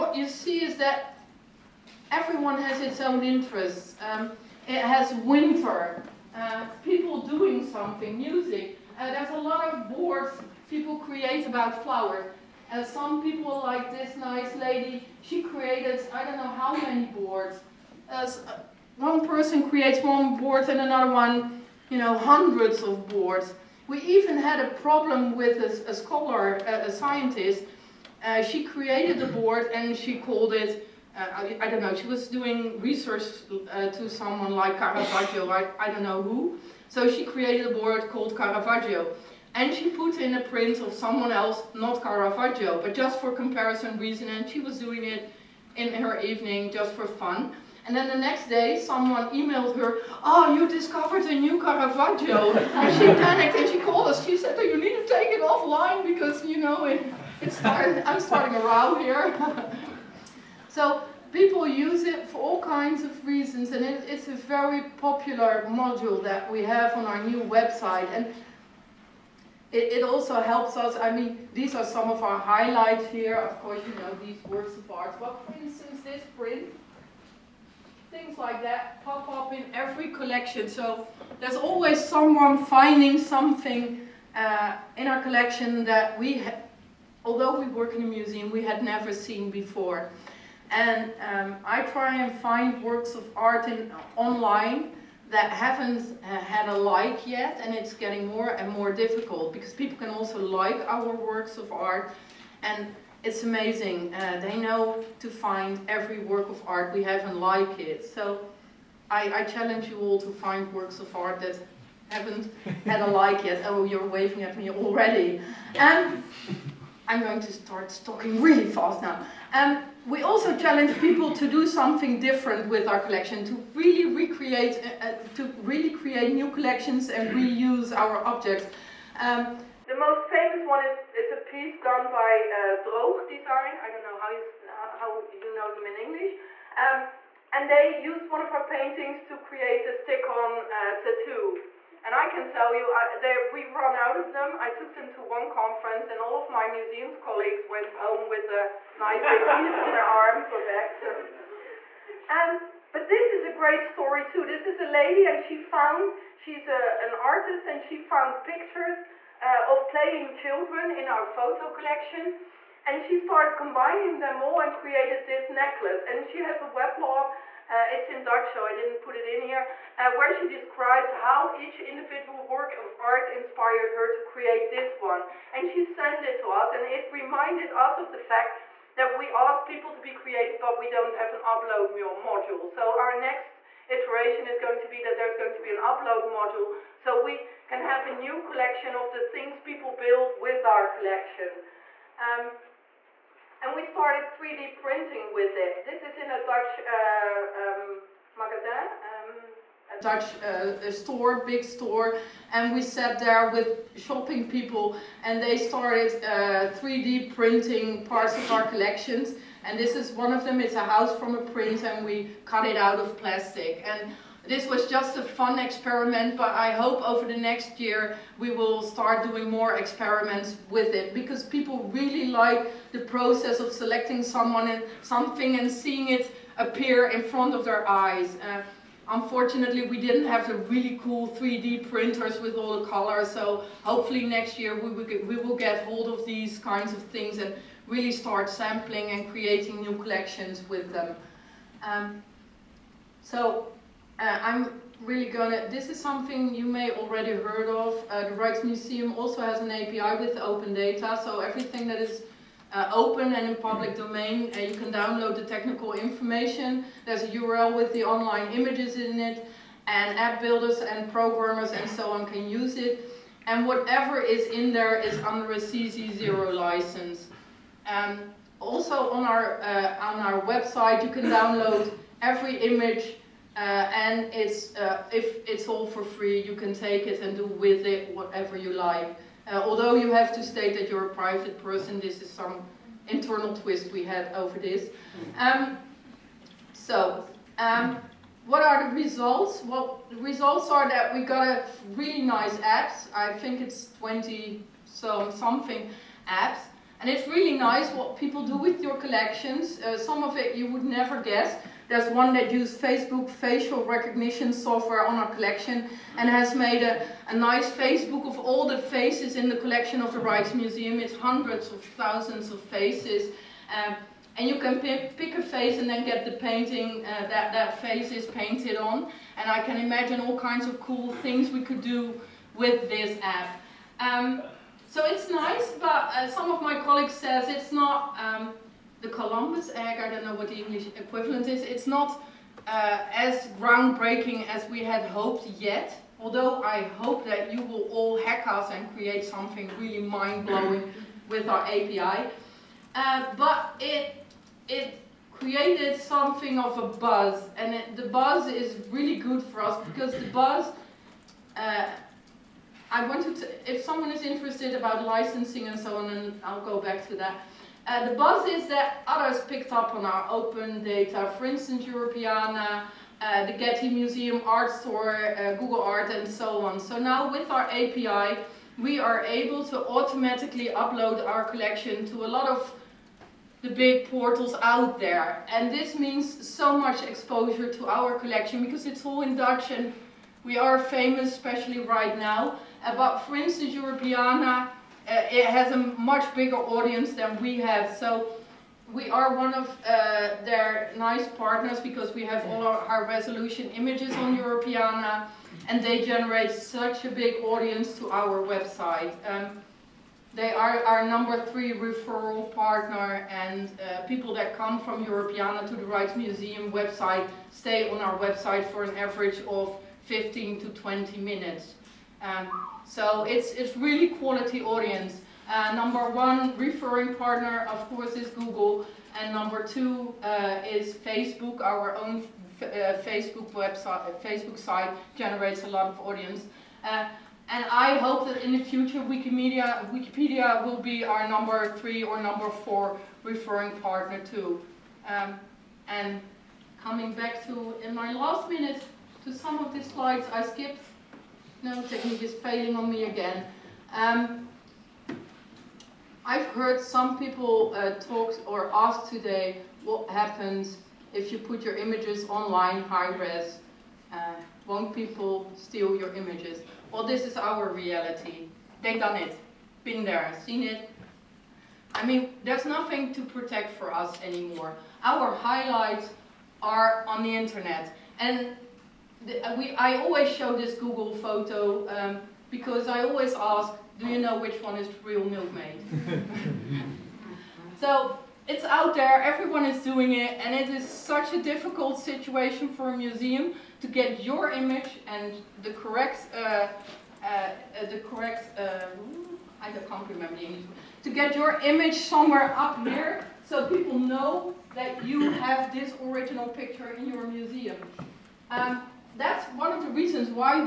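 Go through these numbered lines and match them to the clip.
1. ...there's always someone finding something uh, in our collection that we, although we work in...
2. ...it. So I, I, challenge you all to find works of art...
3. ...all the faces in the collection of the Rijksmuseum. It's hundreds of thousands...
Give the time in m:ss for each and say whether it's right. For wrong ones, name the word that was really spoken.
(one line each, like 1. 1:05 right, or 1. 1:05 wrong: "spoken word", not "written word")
1. 1:21 right
2. 1:47 right
3. 5:08 right.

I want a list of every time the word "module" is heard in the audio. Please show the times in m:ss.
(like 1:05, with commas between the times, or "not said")
1:05, 3:01, 3:06.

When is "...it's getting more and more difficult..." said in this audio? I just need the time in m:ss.
1:37.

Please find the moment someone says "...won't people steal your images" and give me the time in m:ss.
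7:34.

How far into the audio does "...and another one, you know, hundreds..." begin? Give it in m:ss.
0:20.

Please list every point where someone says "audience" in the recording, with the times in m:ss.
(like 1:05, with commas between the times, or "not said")
6:26, 6:37, 6:54, 7:05.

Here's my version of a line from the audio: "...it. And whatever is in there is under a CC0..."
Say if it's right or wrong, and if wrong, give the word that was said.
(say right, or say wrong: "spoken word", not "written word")
right.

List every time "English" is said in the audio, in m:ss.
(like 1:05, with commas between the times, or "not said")
2:15, 5:30, 8:10.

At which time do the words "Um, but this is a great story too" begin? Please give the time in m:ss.
2:32.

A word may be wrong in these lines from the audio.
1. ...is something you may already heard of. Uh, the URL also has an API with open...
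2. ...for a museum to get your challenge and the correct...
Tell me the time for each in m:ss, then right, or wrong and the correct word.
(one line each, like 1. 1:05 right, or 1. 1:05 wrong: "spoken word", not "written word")
1. 4:05 wrong: "Rijksmuseum", not "URL"
2. 8:02 wrong: "image", not "challenge".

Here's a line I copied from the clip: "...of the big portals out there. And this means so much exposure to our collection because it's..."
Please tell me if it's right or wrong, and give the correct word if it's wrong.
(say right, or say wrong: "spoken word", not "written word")
right.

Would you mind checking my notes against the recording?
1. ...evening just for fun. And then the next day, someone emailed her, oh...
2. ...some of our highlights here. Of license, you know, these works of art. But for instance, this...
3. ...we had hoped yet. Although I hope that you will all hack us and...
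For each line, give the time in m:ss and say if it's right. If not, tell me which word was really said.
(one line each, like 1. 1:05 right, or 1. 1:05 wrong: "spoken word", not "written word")
1. 0:46 right
2. 1:11 wrong: "course", not "license"
3. 5:34 right.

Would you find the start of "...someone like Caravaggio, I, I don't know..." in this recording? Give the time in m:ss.
0:34.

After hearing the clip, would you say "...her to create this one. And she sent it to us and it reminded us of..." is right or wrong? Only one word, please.
right.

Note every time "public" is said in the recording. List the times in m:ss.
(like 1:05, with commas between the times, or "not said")
4:13.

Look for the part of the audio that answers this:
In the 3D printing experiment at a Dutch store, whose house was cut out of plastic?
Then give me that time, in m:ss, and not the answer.
3:31.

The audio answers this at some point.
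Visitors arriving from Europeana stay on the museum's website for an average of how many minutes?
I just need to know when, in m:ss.
6:50.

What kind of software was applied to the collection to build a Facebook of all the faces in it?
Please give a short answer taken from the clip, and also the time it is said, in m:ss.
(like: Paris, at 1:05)
Facial recognition software, at 5:03.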